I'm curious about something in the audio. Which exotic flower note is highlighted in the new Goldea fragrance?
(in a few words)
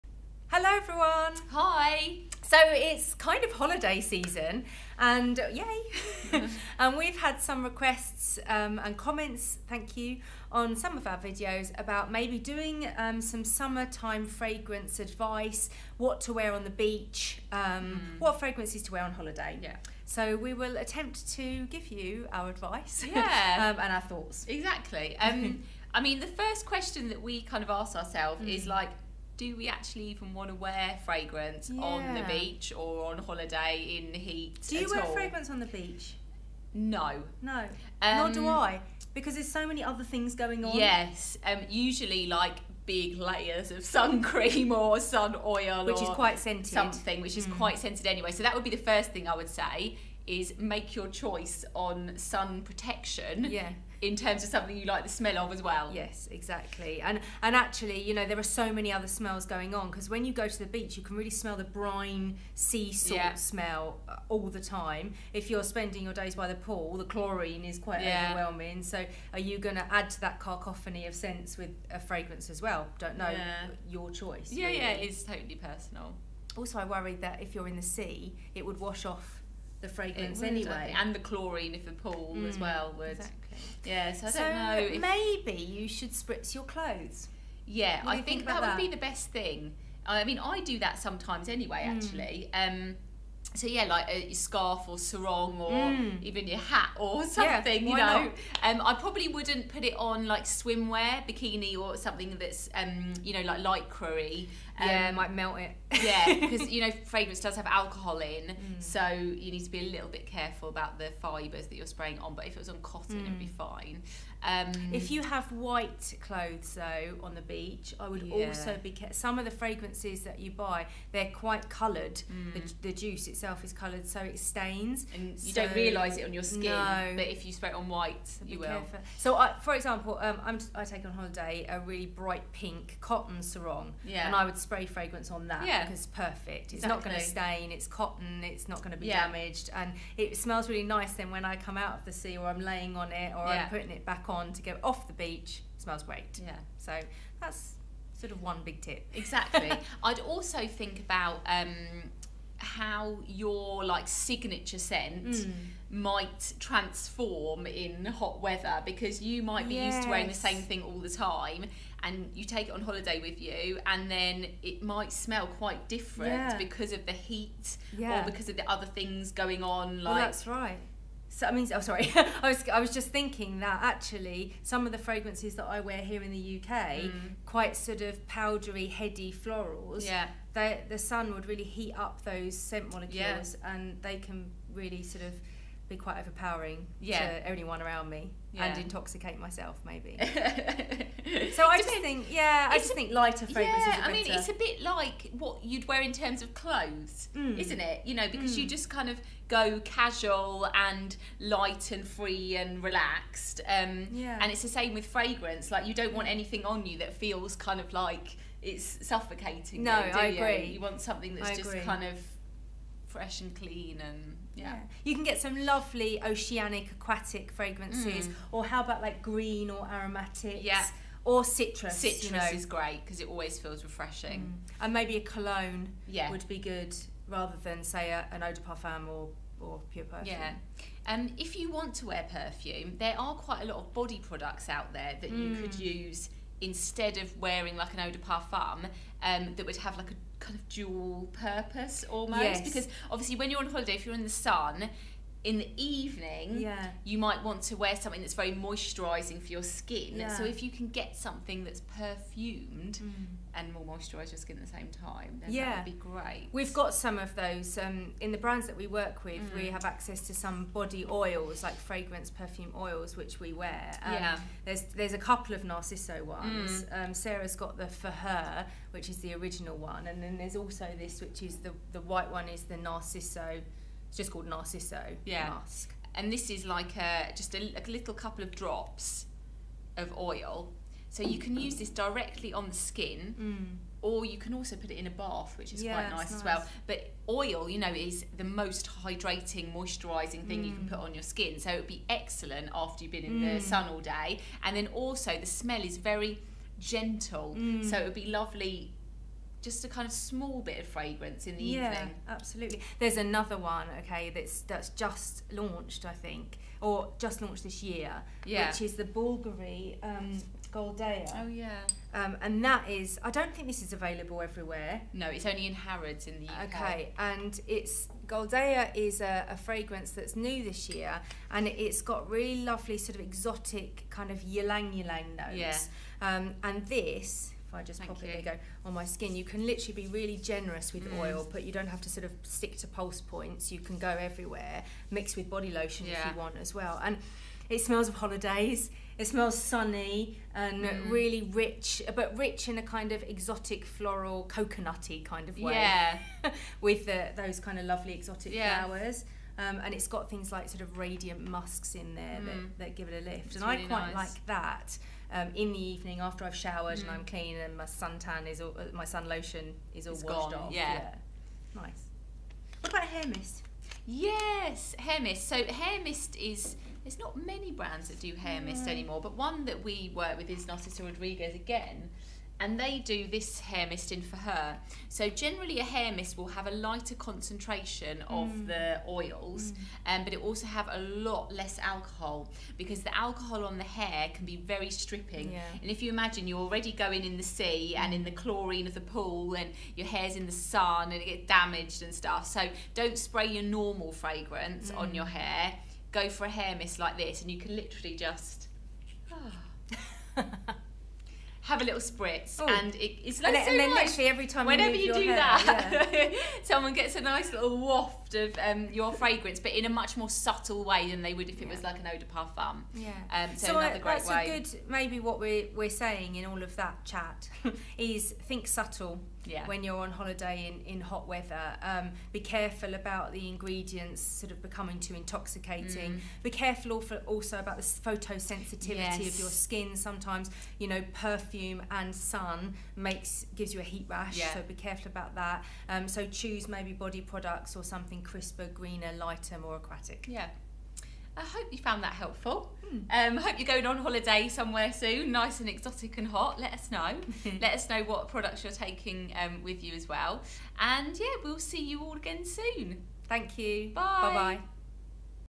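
Ylang ylang.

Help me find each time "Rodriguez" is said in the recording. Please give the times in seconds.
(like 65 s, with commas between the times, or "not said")
371 s.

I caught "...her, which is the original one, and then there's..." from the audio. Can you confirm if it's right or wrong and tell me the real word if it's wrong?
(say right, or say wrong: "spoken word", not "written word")
right.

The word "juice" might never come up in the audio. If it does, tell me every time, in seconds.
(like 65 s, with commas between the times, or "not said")
122 s.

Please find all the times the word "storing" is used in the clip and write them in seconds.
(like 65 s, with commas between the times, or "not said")
not said.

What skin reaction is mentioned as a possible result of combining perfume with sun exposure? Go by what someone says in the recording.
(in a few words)
Heat rash.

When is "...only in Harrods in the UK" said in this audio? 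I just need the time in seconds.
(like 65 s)
315 s.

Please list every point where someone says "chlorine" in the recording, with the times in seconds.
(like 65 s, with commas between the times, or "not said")
67 s, 81 s, 388 s.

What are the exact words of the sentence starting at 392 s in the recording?
So don't spray your normal fragrance mm.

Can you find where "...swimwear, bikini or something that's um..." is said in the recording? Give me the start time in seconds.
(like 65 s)
100 s.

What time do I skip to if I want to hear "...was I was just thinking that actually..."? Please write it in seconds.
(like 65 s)
172 s.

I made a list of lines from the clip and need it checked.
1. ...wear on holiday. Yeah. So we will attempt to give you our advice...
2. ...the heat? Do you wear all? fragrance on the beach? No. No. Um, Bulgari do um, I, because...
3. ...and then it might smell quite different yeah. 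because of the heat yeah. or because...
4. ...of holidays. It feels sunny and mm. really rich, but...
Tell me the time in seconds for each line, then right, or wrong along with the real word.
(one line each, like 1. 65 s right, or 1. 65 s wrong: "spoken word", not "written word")
1. 18 s right
2. 34 s wrong: "Nor", not "Bulgari"
3. 163 s right
4. 338 s wrong: "smells", not "feels".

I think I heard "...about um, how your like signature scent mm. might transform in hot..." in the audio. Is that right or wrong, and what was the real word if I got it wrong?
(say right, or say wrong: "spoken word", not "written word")
right.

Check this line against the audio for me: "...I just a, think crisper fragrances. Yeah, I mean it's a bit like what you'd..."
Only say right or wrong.
wrong.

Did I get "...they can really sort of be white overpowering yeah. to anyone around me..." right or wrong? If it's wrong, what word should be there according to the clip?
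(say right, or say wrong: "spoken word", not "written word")
wrong: "quite", not "white".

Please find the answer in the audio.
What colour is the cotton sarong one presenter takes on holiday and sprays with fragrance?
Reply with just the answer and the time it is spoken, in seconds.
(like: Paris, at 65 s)
Bright pink, at 131 s.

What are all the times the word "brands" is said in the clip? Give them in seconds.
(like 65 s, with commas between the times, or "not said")
258 s, 367 s.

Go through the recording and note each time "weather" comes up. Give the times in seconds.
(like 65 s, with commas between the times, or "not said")
158 s, 421 s.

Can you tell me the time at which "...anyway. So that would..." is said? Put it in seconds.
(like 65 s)
48 s.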